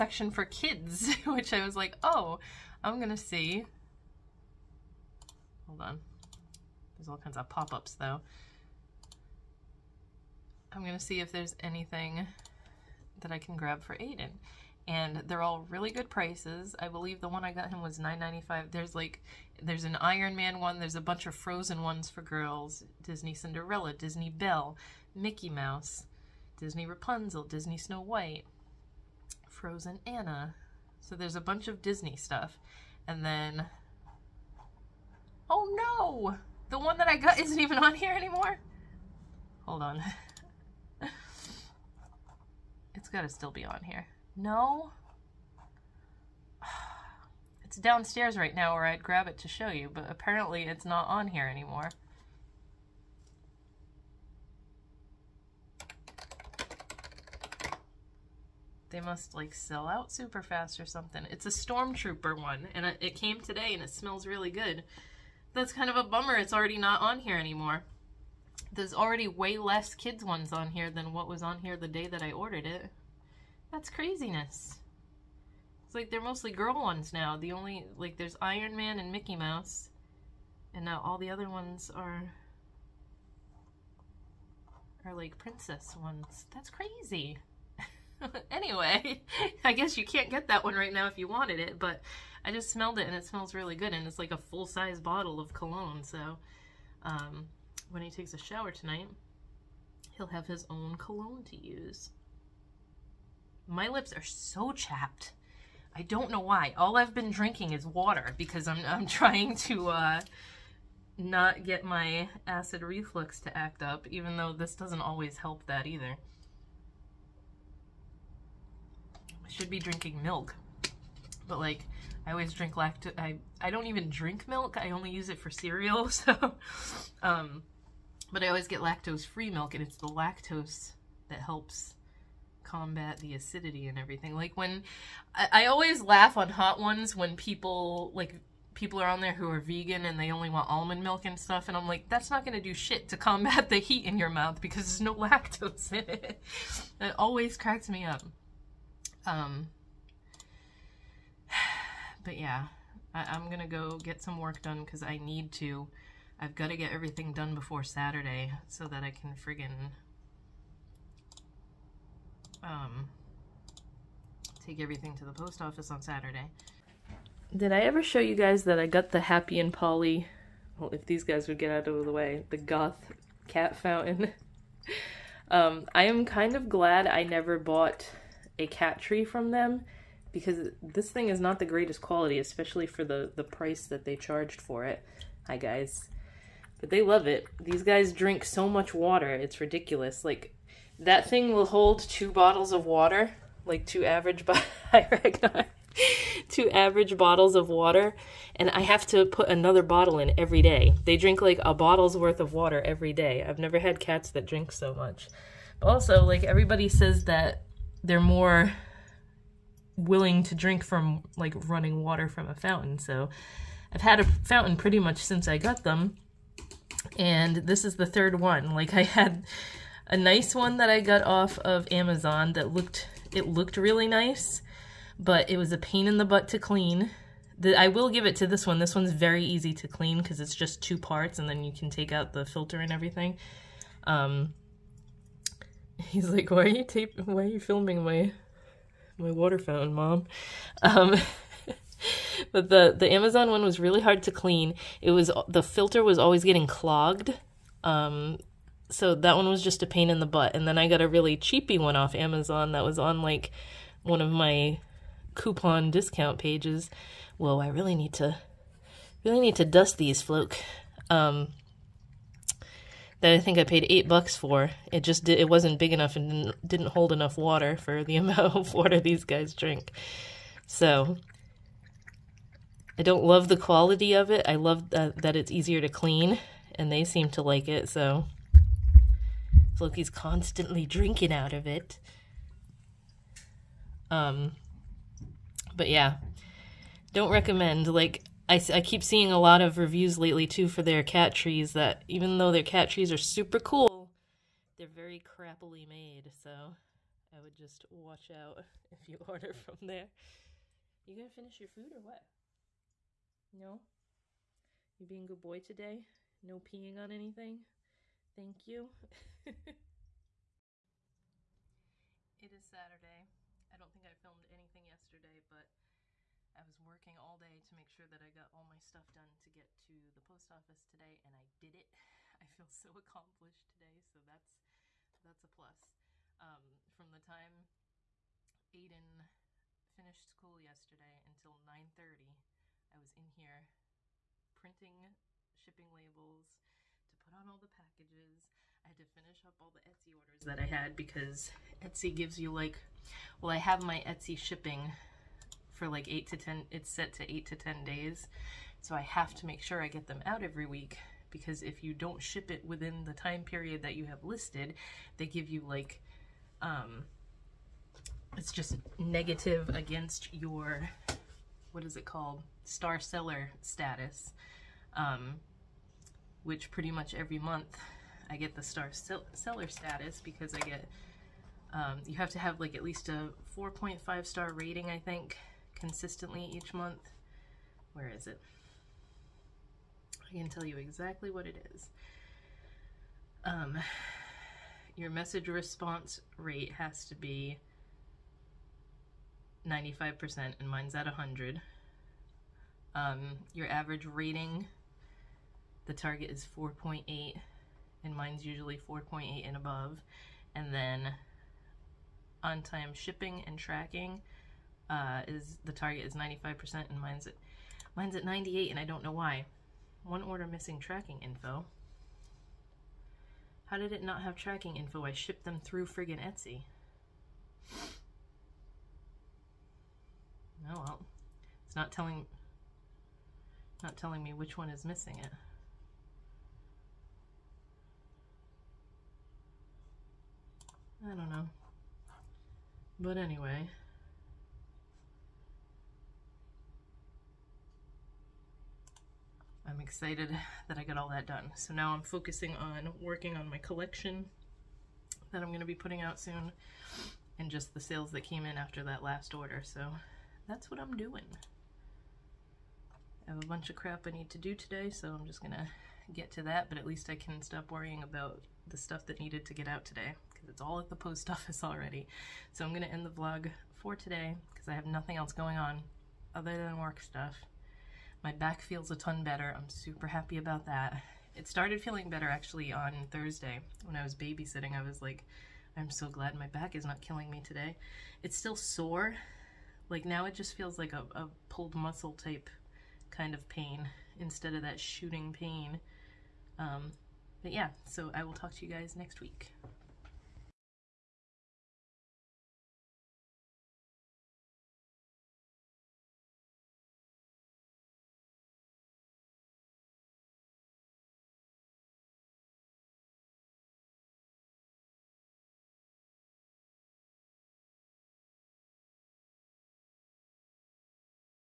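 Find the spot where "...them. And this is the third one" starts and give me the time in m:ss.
3:35.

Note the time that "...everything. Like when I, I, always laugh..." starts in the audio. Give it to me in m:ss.
2:13.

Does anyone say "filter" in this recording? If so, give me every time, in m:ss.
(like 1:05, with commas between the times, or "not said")
3:52, 4:05.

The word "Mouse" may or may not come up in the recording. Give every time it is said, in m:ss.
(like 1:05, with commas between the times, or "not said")
0:25, 1:19.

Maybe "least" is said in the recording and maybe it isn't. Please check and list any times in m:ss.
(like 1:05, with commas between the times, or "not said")
6:12, 7:36.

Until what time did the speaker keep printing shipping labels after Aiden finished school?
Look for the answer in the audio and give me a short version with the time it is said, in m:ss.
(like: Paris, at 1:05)
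9:30, at 5:31.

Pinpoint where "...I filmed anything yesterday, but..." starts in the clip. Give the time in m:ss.
5:14.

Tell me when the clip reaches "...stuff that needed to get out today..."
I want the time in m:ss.
7:38.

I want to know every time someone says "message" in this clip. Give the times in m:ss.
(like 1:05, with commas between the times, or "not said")
6:25.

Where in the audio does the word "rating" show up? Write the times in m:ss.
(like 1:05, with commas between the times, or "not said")
6:14, 6:34.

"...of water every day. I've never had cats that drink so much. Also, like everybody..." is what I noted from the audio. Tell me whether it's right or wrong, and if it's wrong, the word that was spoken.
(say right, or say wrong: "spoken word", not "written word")
right.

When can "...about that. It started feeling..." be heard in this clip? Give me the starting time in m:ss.
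7:50.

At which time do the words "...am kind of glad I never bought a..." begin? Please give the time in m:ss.
2:56.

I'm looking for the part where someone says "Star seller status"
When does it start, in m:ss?
6:02.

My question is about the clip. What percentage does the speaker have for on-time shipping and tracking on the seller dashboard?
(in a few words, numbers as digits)
98%.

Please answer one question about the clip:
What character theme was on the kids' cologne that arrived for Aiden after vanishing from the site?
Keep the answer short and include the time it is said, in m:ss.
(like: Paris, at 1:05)
Stormtrooper, at 1:01.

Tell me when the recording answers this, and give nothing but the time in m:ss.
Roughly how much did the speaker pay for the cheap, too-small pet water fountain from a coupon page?
4:23.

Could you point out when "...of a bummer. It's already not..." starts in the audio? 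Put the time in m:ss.
1:05.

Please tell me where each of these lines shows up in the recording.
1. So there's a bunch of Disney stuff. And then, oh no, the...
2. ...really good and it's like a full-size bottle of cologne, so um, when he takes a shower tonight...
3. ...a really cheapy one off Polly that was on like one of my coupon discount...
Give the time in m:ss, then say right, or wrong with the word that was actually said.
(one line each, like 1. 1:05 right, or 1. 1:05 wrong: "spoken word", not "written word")
1. 0:31 right
2. 1:33 right
3. 4:11 wrong: "Amazon", not "Polly".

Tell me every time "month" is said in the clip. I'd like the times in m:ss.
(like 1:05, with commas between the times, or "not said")
6:07, 6:16.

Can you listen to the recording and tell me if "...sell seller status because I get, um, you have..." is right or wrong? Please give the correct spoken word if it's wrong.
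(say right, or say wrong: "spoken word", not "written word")
right.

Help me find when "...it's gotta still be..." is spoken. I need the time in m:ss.
0:42.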